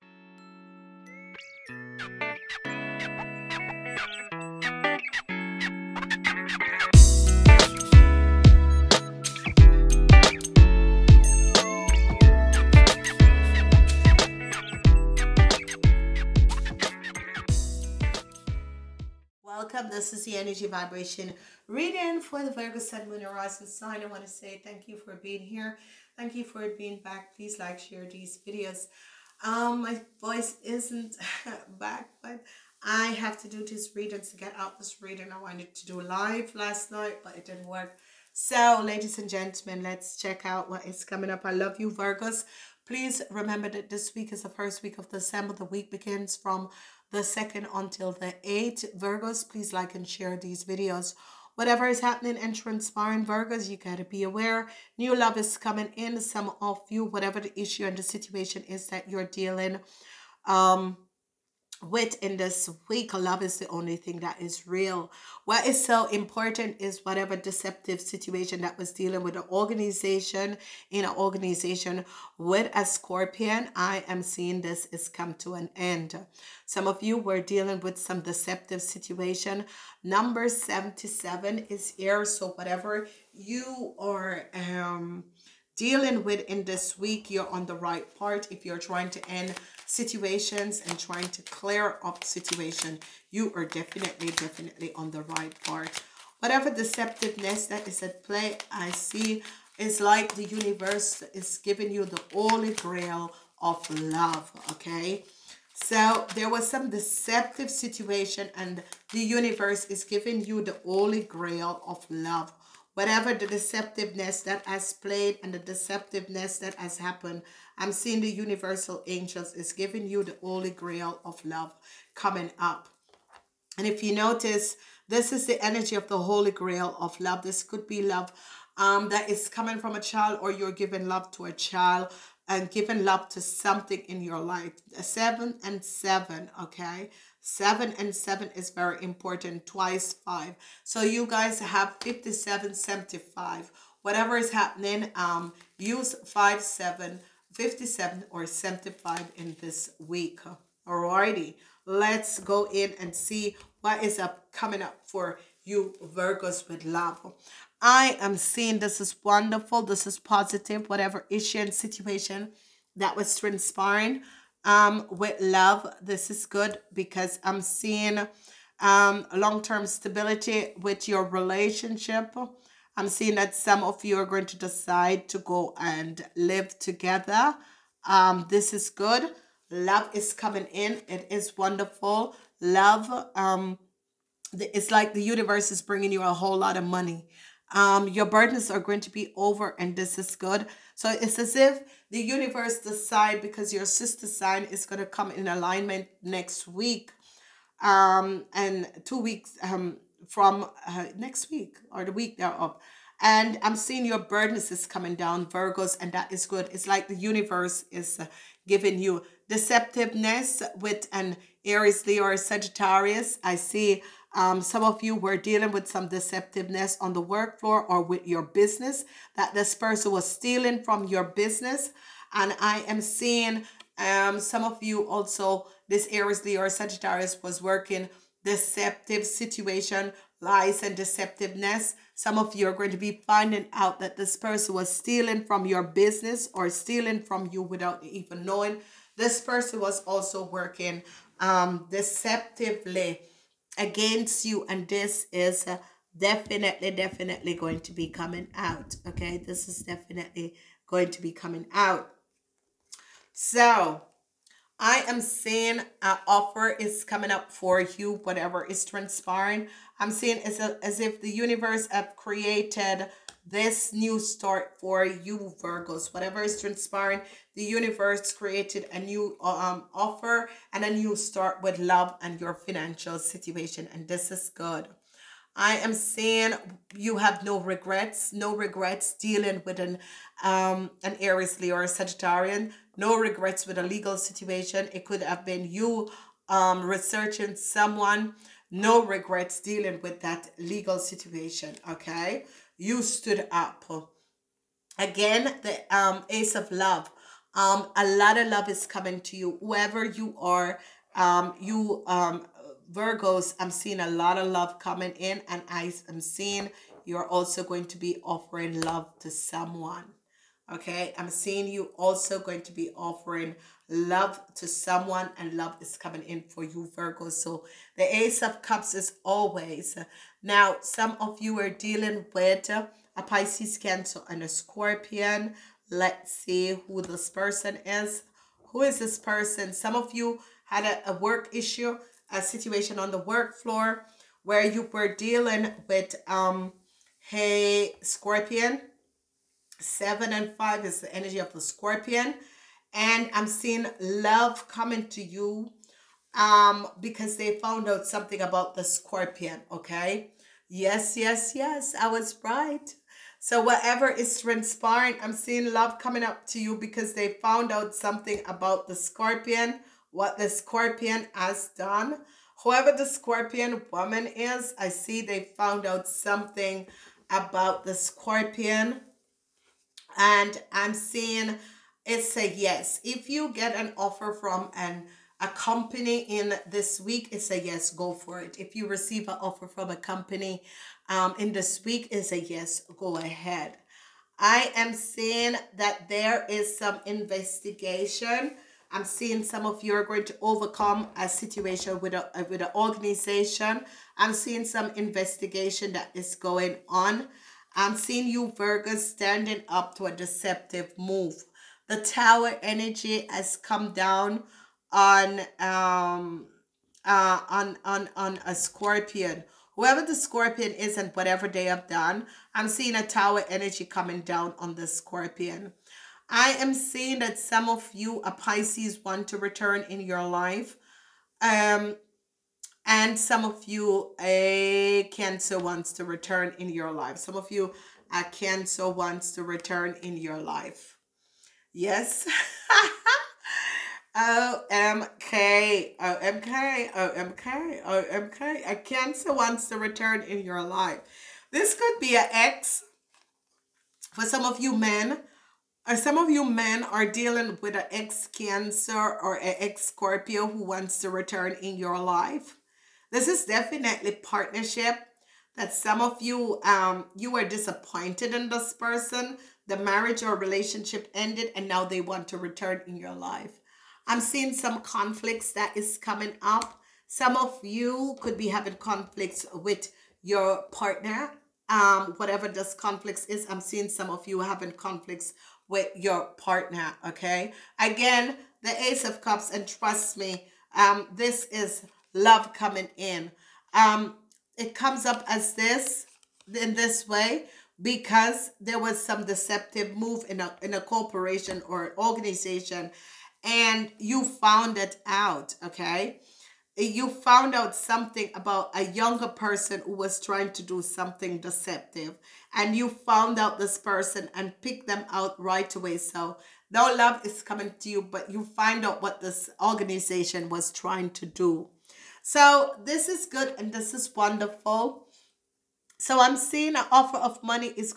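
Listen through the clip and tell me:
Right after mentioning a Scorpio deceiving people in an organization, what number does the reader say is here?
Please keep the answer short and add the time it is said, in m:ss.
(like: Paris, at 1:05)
77, at 1:20.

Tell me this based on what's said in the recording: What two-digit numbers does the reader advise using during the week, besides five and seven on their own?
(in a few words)
57, 75.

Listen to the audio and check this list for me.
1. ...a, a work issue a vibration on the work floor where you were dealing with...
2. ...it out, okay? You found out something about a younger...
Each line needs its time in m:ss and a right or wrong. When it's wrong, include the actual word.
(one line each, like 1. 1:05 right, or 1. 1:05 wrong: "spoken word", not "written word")
1. 5:30 wrong: "situation", not "vibration"
2. 8:14 right.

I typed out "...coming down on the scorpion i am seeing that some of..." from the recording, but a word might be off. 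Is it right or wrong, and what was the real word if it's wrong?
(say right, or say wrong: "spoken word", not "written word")
right.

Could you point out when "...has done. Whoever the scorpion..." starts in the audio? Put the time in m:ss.
6:01.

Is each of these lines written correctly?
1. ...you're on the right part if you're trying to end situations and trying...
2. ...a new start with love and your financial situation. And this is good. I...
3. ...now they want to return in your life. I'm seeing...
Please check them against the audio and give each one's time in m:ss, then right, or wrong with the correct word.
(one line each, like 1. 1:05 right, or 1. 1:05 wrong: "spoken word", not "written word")
1. 1:27 right
2. 4:30 right
3. 7:41 right.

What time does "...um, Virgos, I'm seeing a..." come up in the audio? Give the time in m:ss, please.
5:02.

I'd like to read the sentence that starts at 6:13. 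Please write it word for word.
If you get an offer from an a company in this week, it's a yes, go for it.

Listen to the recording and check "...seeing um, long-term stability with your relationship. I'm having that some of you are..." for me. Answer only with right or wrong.
wrong.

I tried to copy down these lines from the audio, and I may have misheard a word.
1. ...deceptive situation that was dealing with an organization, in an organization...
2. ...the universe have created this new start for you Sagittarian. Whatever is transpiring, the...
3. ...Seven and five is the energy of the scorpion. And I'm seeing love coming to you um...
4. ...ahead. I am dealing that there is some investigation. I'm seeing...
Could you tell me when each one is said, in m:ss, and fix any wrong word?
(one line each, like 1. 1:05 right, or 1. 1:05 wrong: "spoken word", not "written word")
1. 1:07 right
2. 4:21 wrong: "Virgos", not "Sagittarian"
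3. 5:39 right
4. 6:23 wrong: "seeing", not "dealing".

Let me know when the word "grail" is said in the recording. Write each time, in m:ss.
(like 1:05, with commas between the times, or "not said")
1:42, 1:51, 2:00, 2:06.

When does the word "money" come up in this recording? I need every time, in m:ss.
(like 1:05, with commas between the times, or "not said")
3:06, 8:37.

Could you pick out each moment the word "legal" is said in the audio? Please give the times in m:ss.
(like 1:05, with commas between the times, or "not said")
4:43, 4:50.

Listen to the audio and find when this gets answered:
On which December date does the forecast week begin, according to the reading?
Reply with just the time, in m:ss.
0:47.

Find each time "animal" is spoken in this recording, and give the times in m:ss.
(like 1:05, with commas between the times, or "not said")
not said.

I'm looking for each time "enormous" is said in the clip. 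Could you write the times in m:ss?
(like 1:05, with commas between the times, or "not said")
not said.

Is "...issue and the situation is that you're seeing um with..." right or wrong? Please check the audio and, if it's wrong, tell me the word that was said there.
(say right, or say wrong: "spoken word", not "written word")
wrong: "dealing", not "seeing".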